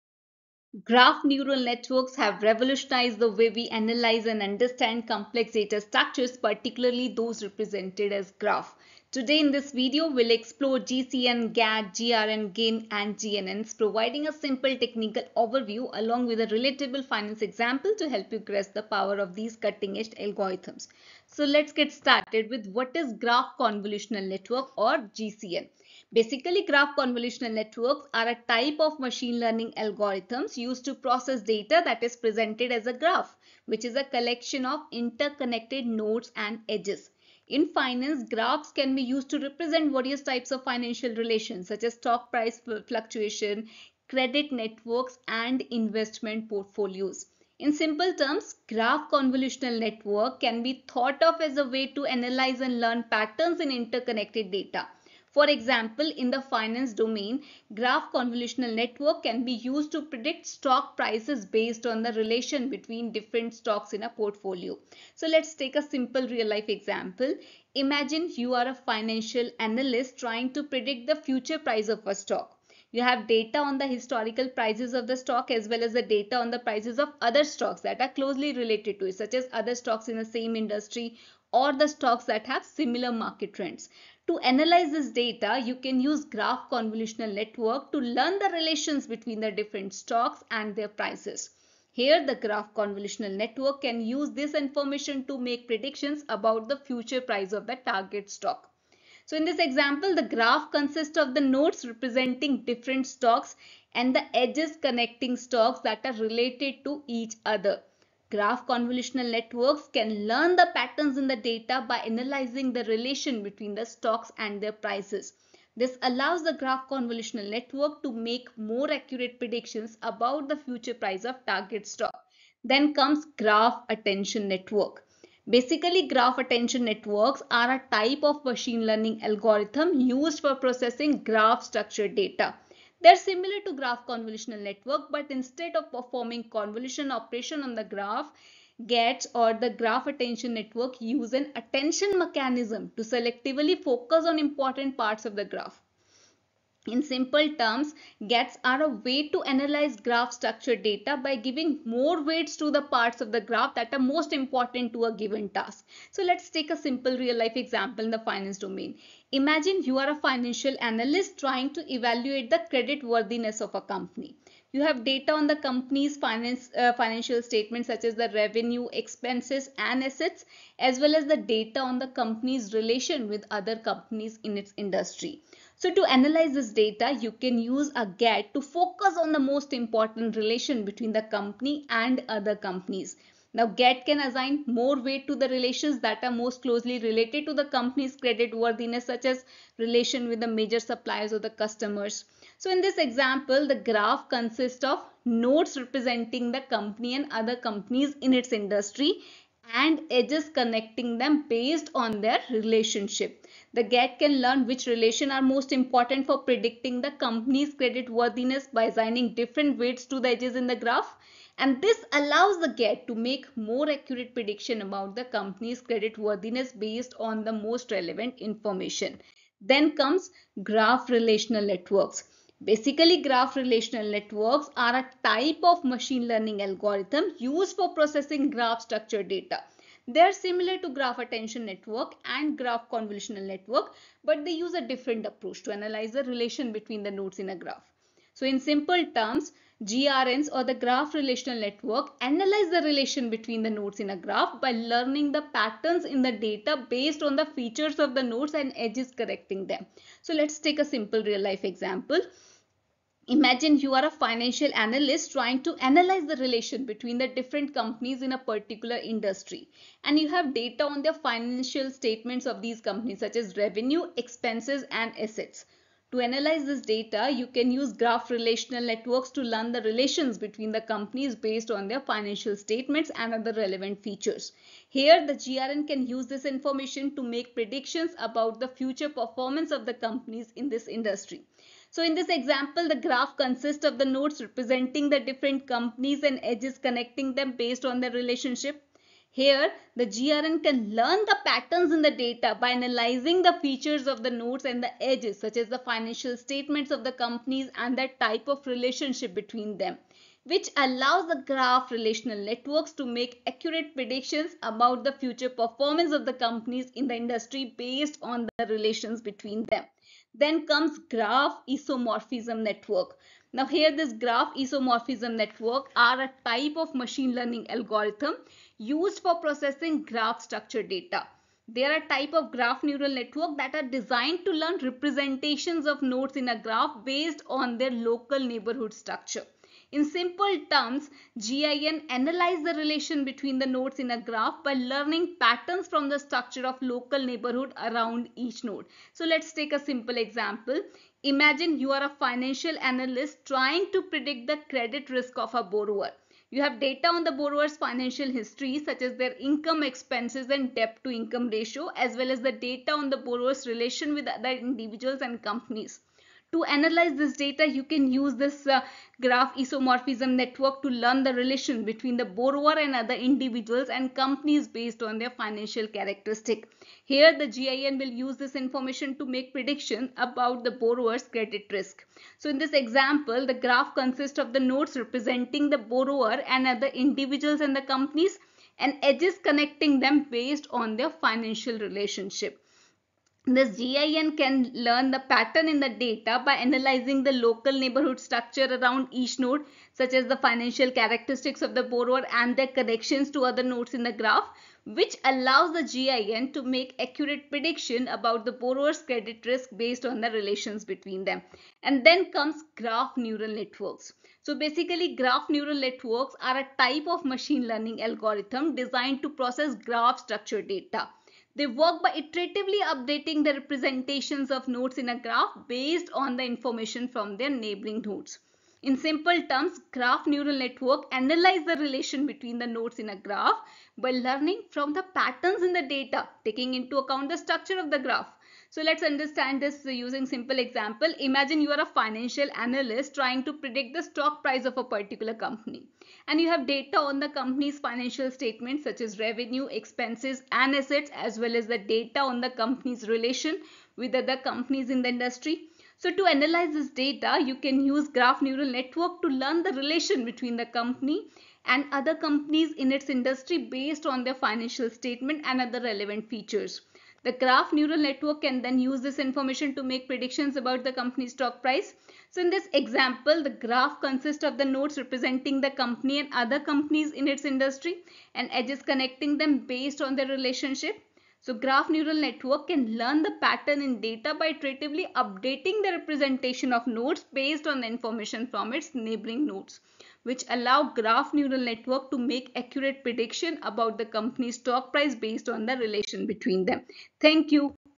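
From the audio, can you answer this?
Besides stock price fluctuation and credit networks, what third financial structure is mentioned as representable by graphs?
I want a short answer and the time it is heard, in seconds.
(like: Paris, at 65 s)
investment portfolios, at 45 s.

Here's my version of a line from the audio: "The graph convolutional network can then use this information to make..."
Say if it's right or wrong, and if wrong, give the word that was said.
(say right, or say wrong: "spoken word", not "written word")
wrong: "neural", not "convolutional".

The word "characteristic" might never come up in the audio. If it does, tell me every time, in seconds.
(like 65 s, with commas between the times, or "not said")
365 s, 390 s.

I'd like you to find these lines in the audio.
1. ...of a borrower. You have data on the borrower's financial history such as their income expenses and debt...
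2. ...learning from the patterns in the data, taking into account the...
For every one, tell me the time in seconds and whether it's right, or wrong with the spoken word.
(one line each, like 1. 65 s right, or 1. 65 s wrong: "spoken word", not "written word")
1. 345 s right
2. 424 s right.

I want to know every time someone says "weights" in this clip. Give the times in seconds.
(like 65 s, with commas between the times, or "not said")
152 s, 185 s, 209 s.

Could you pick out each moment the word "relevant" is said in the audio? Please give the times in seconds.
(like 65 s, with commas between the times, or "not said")
217 s, 273 s, 455 s.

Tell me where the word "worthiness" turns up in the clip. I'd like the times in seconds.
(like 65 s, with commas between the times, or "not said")
163 s, 188 s, 208 s, 216 s.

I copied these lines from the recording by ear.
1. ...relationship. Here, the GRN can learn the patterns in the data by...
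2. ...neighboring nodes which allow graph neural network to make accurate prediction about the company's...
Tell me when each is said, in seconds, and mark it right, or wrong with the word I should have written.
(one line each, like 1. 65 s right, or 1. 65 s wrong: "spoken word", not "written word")
1. 288 s right
2. 478 s right.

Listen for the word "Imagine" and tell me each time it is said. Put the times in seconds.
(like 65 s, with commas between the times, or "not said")
67 s, 159 s, 253 s, 341 s, 431 s.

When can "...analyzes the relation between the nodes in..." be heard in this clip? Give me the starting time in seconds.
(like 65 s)
332 s.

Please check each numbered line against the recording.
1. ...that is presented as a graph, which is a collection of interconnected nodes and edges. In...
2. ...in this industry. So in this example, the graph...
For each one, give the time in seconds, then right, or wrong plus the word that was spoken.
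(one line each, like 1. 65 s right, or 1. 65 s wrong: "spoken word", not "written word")
1. 31 s right
2. 280 s right.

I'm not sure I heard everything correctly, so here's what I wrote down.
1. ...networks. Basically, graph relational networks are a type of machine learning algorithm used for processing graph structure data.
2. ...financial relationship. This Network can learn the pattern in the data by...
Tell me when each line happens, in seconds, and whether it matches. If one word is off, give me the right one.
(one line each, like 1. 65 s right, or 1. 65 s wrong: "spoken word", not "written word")
1. 221 s right
2. 381 s wrong: "GIN", not "Network".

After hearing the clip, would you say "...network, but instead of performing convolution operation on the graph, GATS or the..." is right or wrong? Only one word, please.
right.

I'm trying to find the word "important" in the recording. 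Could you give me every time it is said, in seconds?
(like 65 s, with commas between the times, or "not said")
144 s, 154 s, 179 s, 205 s.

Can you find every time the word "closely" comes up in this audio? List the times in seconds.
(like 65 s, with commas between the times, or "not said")
78 s, 186 s.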